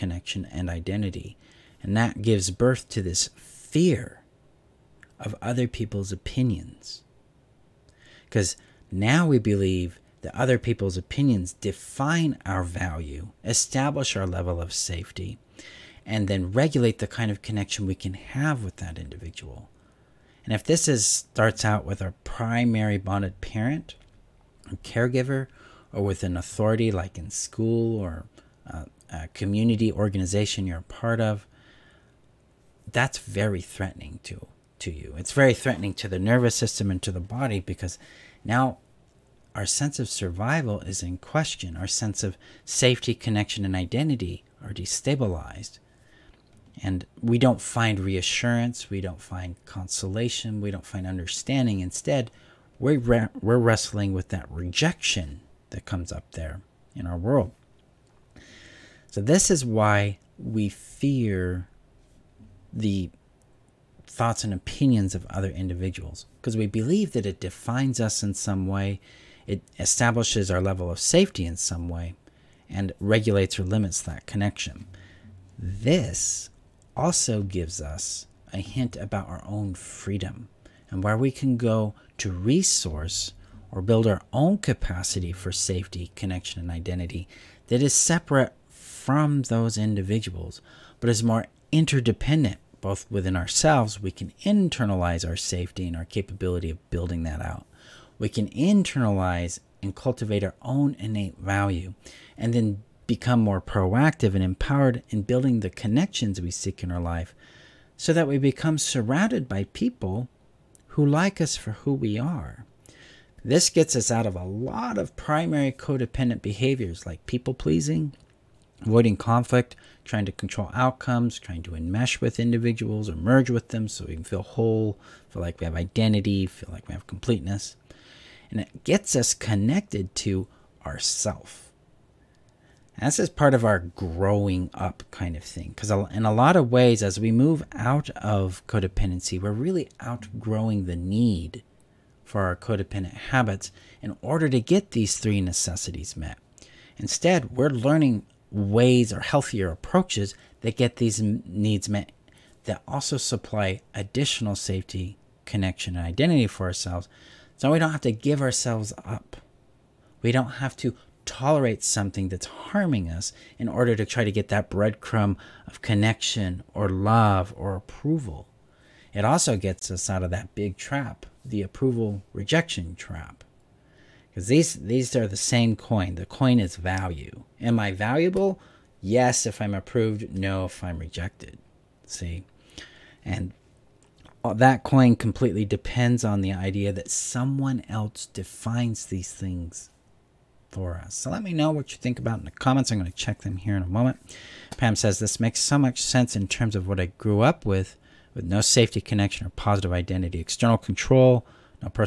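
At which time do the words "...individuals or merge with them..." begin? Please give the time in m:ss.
2:02.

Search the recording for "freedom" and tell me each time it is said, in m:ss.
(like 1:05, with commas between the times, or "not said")
1:19.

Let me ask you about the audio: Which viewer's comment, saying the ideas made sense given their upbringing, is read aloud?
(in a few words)
Pam.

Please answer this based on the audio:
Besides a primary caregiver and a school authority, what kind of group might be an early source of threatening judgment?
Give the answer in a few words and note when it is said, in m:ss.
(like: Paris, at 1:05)
community organization, at 0:29.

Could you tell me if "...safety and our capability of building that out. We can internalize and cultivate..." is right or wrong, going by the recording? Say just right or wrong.
right.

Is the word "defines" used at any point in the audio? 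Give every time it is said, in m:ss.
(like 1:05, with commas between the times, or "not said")
0:11, 1:07, 3:08.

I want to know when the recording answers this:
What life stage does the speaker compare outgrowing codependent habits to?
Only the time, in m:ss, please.
2:13.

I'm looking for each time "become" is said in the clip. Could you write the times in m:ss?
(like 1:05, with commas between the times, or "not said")
1:43, 1:48.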